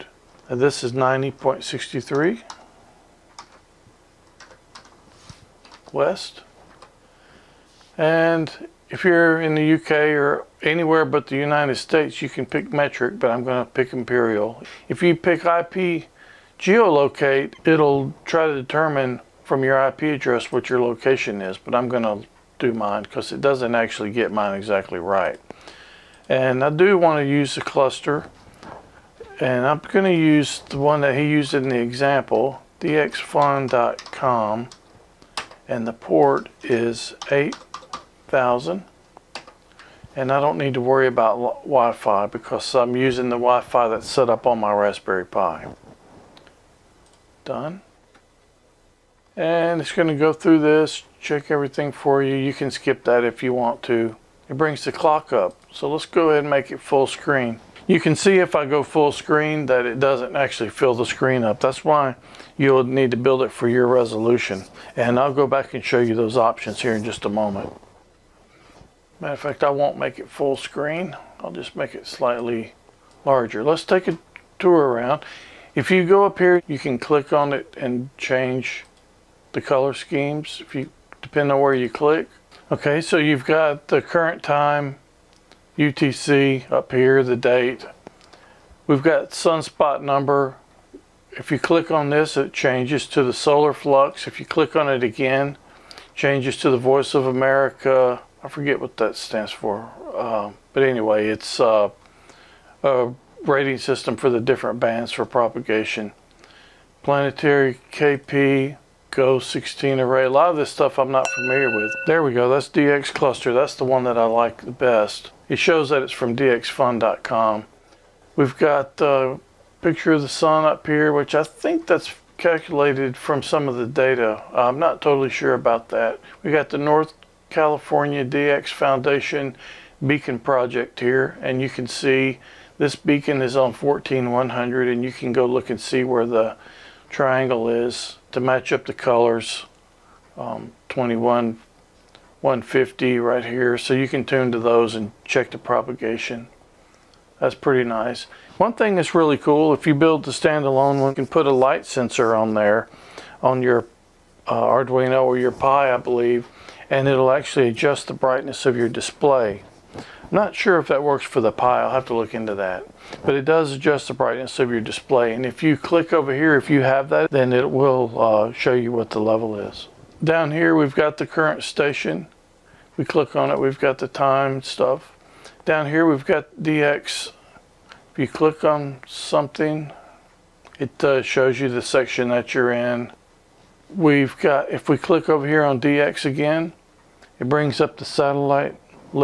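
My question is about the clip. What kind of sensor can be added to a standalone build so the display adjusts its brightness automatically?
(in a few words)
light sensor.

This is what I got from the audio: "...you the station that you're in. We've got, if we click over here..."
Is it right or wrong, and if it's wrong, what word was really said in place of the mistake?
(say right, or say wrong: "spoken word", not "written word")
wrong: "section", not "station".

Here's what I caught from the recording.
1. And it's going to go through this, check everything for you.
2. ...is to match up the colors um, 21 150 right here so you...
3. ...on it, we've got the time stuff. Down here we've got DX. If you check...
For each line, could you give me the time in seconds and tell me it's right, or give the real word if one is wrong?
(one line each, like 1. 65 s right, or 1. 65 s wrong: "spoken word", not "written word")
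1. 49 s right
2. 137 s right
3. 173 s wrong: "click", not "check".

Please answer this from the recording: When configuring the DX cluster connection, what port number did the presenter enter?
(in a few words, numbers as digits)
8000.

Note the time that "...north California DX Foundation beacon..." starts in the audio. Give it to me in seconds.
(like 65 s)
126 s.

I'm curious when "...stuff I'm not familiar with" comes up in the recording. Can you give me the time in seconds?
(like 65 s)
110 s.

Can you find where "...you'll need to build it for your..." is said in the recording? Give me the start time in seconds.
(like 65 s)
62 s.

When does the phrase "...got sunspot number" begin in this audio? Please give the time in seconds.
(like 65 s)
89 s.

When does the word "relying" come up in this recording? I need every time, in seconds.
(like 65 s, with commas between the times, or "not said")
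not said.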